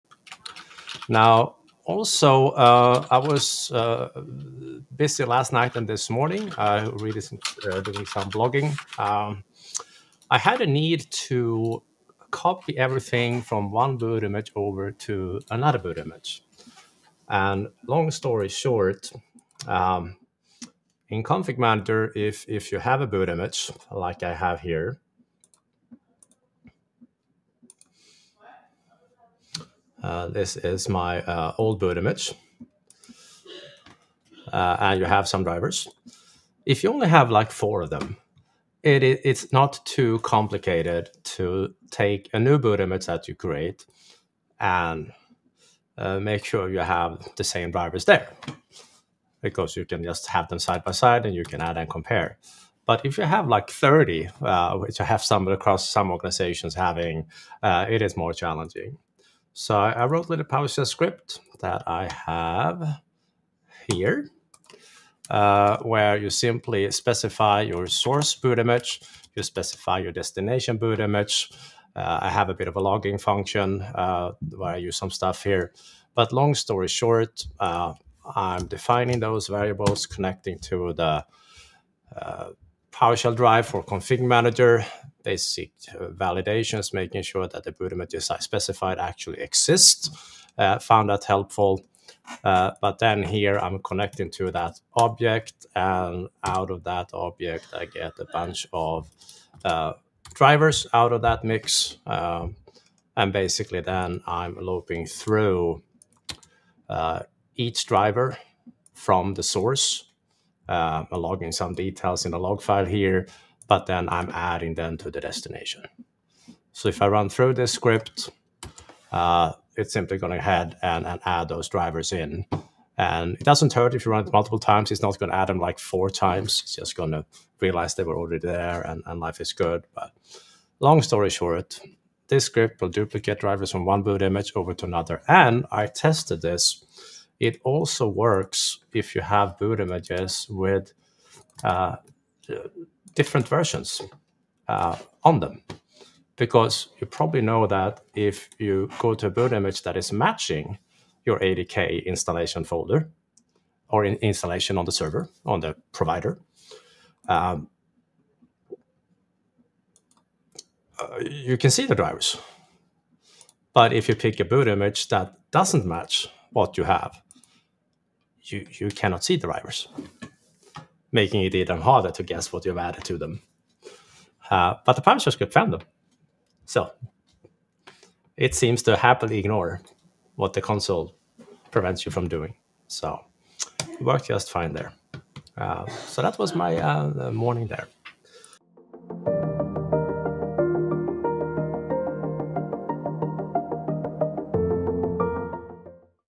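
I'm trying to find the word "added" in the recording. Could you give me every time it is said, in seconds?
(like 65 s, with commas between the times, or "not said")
172 s.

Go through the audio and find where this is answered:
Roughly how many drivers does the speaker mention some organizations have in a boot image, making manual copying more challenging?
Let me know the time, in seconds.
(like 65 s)
53 s.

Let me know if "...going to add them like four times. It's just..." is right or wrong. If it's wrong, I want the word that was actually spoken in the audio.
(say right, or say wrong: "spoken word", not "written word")
right.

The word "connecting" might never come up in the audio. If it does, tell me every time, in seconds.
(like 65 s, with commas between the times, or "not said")
80 s, 93 s.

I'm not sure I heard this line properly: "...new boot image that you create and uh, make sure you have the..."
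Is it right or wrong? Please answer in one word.
right.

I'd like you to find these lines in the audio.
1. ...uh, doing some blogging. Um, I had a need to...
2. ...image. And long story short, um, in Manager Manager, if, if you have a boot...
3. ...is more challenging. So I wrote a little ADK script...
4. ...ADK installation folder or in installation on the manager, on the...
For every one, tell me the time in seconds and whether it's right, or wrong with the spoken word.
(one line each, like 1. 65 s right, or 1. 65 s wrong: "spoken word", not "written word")
1. 7 s right
2. 15 s wrong: "Config", not "Manager"
3. 58 s wrong: "PowerShell", not "ADK"
4. 151 s wrong: "server", not "manager".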